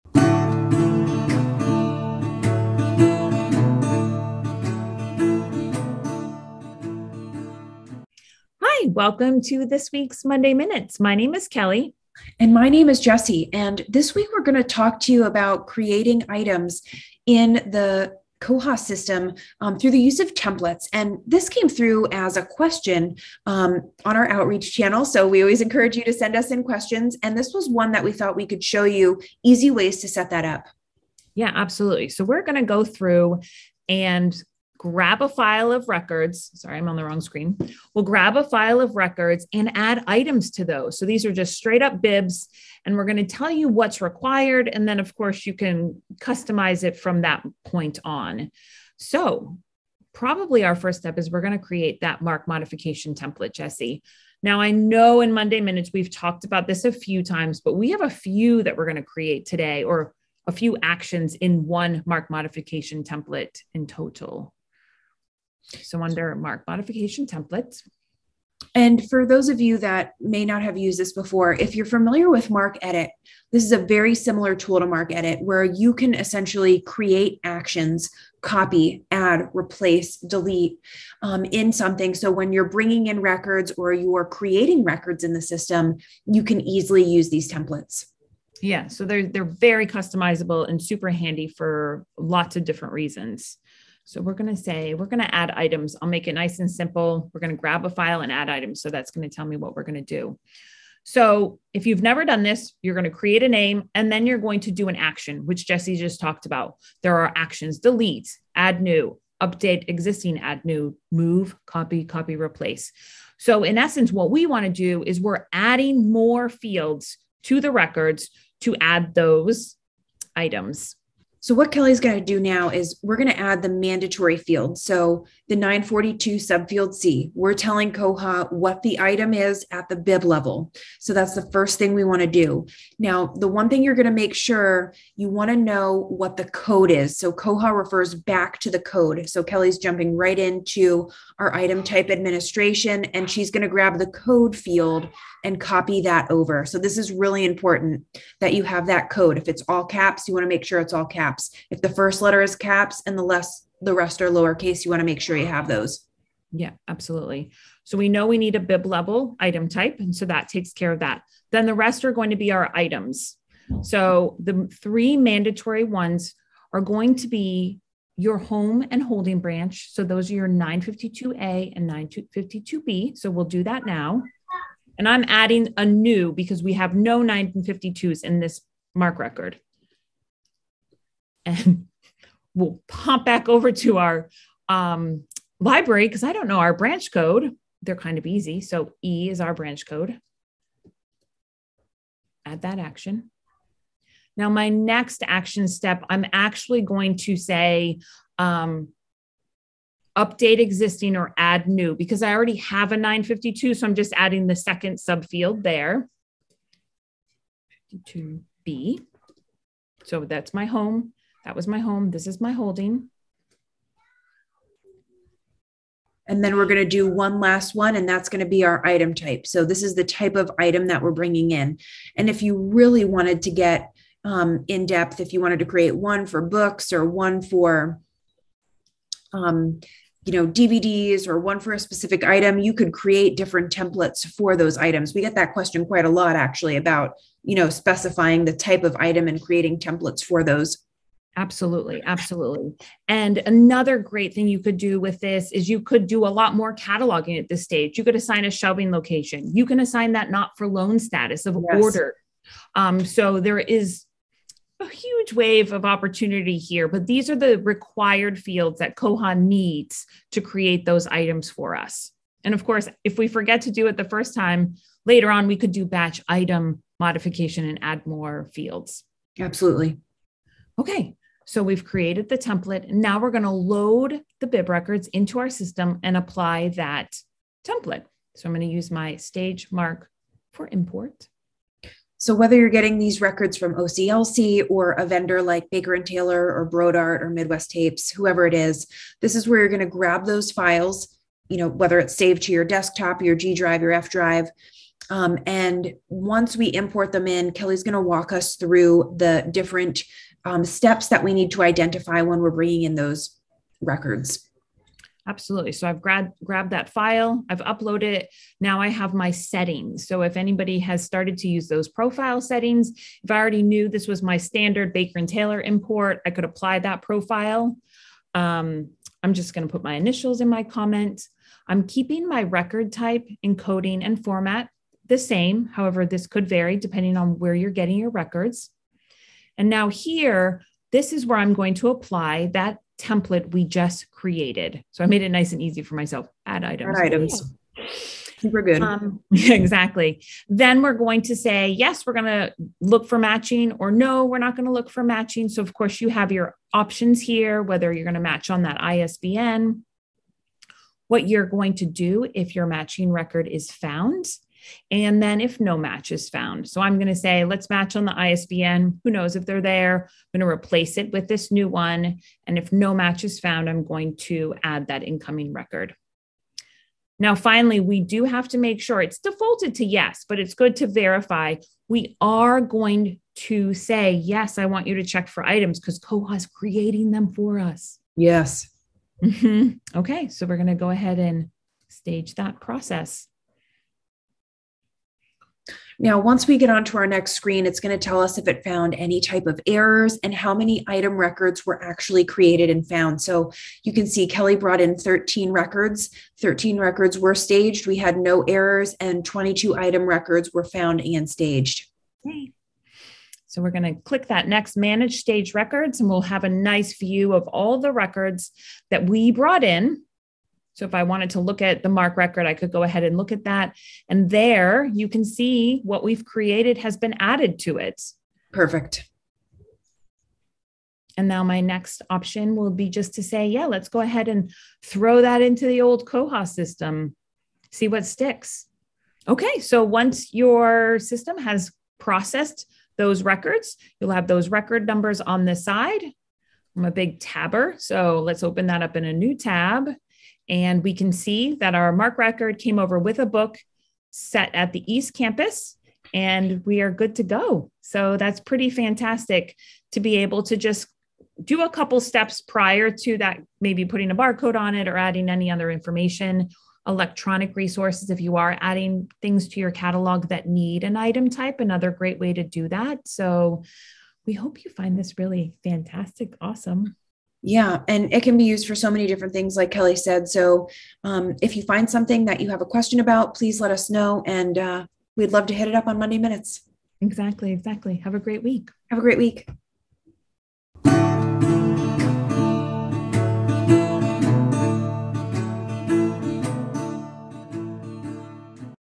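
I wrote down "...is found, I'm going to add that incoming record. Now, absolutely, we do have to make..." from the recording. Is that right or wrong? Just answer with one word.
wrong.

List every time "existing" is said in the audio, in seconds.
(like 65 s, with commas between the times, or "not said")
109 s, 200 s.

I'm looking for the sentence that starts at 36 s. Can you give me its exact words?
Sorry, I'm on the wrong screen.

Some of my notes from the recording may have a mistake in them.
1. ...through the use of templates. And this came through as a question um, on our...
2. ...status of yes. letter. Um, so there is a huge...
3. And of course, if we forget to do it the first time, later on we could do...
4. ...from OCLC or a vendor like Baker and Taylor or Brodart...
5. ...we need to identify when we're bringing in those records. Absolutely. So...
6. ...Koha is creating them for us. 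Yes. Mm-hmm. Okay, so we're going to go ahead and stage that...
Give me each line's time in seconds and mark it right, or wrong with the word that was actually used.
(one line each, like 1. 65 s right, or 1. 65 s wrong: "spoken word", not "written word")
1. 19 s right
2. 250 s wrong: "order", not "letter"
3. 262 s right
4. 283 s right
5. 301 s right
6. 375 s right.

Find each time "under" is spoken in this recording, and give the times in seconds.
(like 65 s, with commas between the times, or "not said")
66 s.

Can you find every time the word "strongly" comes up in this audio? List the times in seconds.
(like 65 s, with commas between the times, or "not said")
not said.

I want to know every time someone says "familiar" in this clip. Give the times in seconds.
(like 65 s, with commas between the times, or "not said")
71 s.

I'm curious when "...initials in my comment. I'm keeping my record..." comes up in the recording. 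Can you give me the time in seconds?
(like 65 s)
319 s.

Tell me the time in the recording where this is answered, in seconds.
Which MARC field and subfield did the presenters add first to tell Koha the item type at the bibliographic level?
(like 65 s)
125 s.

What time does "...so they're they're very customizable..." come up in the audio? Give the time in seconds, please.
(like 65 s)
88 s.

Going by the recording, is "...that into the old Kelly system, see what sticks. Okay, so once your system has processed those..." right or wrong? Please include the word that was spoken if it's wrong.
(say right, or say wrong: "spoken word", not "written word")
wrong: "Koha", not "Kelly".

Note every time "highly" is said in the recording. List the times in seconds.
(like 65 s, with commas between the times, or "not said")
not said.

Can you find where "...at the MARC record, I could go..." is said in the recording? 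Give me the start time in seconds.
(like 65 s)
411 s.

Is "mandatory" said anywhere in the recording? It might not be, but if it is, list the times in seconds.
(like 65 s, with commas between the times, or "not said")
123 s, 165 s.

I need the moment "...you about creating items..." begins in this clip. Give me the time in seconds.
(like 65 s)
15 s.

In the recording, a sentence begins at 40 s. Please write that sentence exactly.
So these are just straight up bibs, and we're going to tell you what's required.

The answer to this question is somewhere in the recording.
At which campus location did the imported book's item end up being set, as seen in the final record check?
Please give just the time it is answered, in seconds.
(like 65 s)
444 s.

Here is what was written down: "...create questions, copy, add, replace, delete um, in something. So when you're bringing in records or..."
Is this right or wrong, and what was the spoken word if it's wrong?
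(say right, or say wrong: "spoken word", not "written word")
wrong: "actions", not "questions".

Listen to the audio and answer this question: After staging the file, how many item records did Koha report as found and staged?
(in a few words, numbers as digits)
22.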